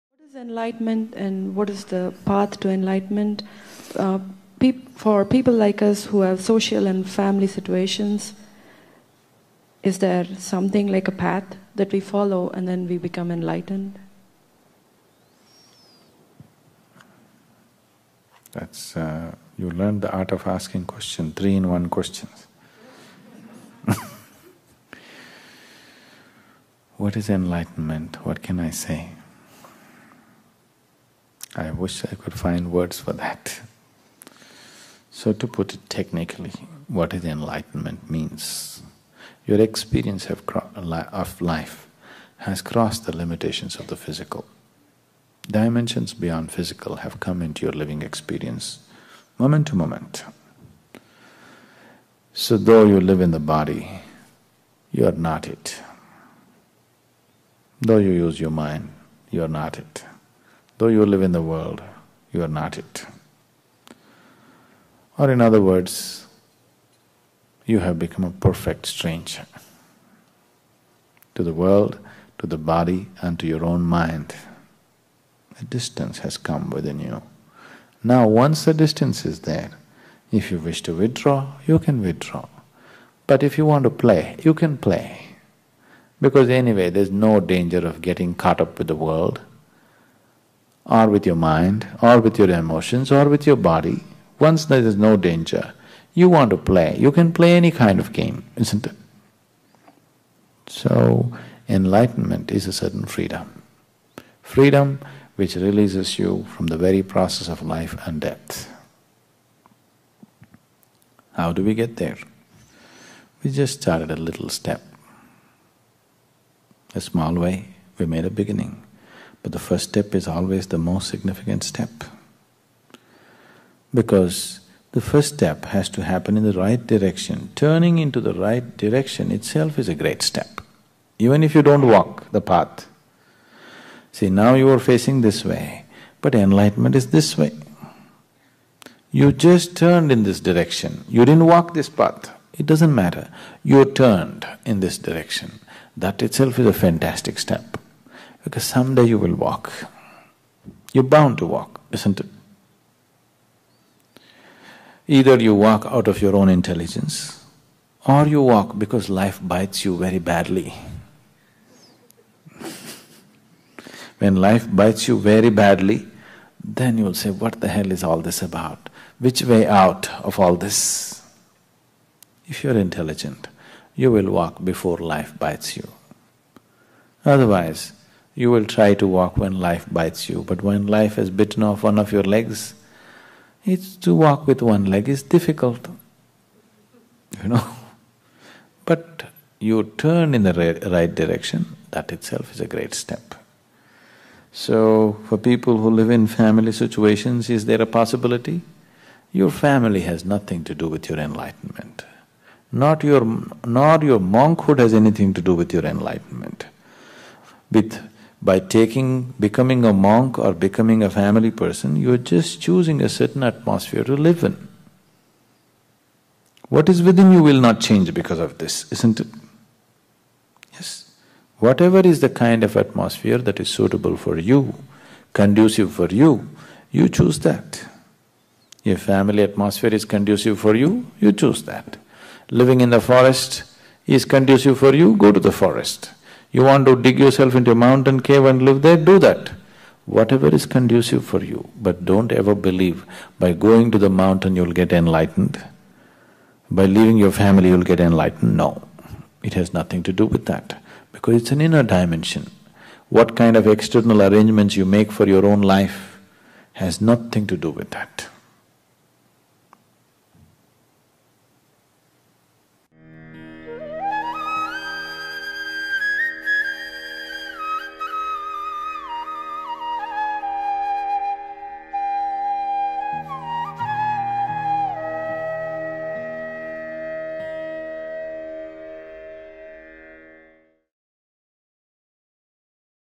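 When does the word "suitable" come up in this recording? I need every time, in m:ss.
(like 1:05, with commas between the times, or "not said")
3:43.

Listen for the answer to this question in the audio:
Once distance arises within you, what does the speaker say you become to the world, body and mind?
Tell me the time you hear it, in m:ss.
1:08.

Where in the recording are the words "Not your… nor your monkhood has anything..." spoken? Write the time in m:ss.
3:22.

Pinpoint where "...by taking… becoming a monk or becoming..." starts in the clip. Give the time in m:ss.
3:28.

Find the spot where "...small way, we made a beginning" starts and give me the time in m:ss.
1:57.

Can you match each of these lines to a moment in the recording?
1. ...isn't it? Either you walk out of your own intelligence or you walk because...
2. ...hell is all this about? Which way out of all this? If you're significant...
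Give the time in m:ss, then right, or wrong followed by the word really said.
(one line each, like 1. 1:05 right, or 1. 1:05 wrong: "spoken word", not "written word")
1. 2:31 right
2. 2:47 wrong: "intelligent", not "significant".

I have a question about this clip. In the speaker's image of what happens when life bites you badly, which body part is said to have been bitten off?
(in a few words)
one of your legs.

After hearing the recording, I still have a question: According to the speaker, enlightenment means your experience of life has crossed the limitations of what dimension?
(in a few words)
the physical.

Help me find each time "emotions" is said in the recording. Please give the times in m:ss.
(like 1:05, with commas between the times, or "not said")
1:32.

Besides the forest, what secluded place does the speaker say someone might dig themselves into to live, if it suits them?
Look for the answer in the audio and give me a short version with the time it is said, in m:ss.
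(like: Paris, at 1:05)
mountain cave, at 3:57.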